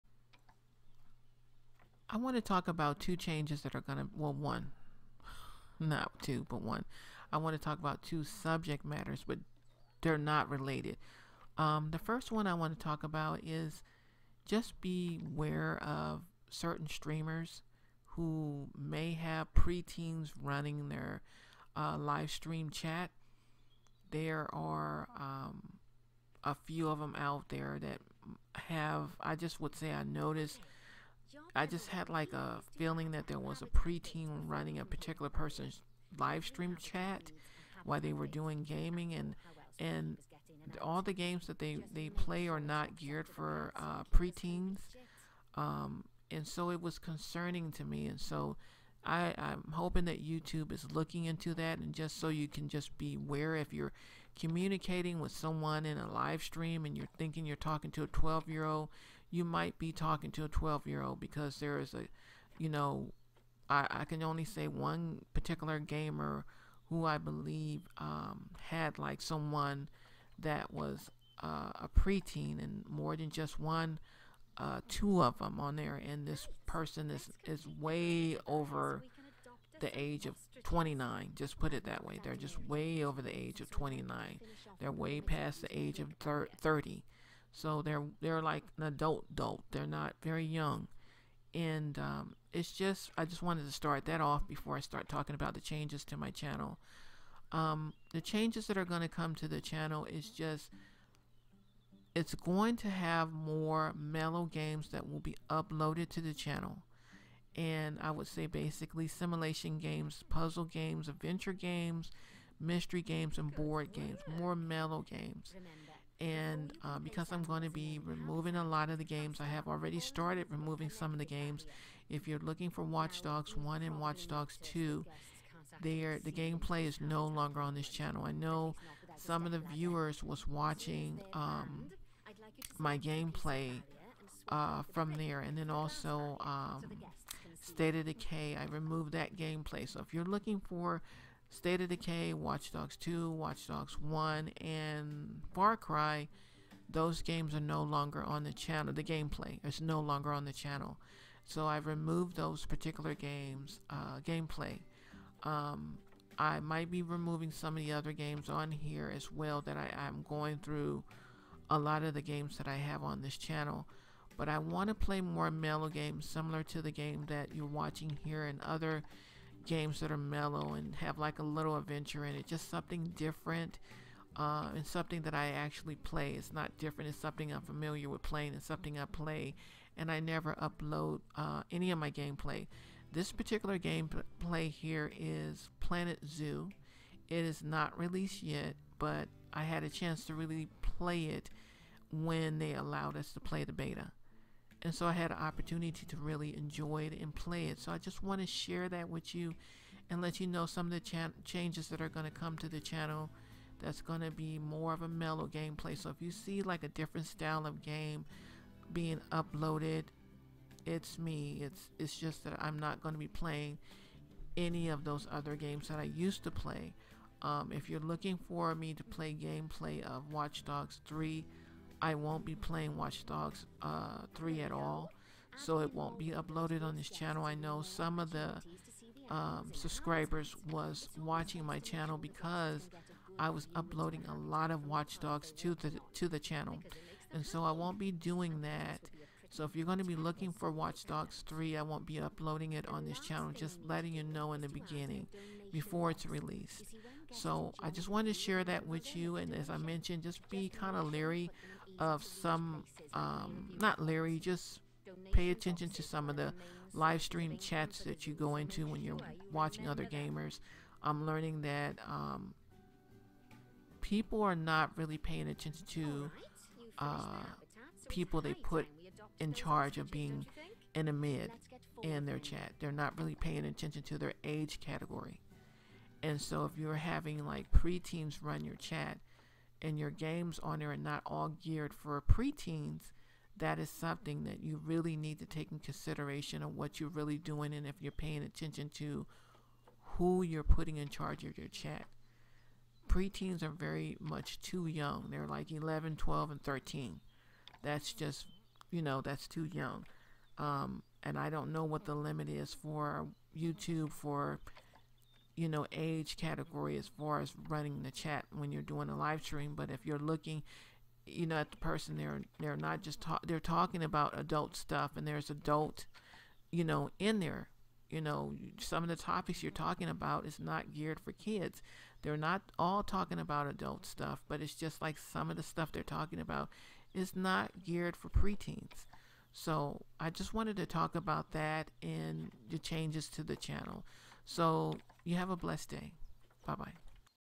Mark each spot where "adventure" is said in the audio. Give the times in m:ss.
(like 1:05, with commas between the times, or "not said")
1:51, 2:51.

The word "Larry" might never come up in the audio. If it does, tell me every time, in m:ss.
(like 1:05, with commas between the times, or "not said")
4:14.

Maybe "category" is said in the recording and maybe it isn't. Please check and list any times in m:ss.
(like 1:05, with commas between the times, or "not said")
4:34, 5:06.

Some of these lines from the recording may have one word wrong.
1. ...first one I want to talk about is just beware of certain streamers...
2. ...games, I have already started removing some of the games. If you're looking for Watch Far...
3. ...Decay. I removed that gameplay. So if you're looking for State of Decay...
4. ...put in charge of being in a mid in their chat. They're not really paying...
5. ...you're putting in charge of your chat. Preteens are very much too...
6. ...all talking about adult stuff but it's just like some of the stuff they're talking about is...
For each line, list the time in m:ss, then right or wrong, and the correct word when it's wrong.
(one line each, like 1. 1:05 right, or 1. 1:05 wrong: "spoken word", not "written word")
1. 0:11 right
2. 1:59 wrong: "Dogs", not "Far"
3. 2:18 right
4. 4:28 right
5. 4:50 right
6. 5:22 right.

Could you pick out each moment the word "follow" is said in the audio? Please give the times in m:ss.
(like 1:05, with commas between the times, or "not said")
not said.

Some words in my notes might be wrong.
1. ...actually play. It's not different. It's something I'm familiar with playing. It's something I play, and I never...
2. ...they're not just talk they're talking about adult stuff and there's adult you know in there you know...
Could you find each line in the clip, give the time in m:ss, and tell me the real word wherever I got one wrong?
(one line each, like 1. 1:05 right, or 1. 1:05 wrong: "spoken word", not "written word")
1. 2:55 right
2. 5:12 right.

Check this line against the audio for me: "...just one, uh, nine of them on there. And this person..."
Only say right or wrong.
wrong.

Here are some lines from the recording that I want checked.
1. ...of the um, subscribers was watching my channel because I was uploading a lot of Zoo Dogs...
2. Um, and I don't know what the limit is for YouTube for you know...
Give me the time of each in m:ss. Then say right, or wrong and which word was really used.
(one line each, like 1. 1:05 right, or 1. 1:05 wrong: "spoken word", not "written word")
1. 3:48 wrong: "Watch", not "Zoo"
2. 5:00 right.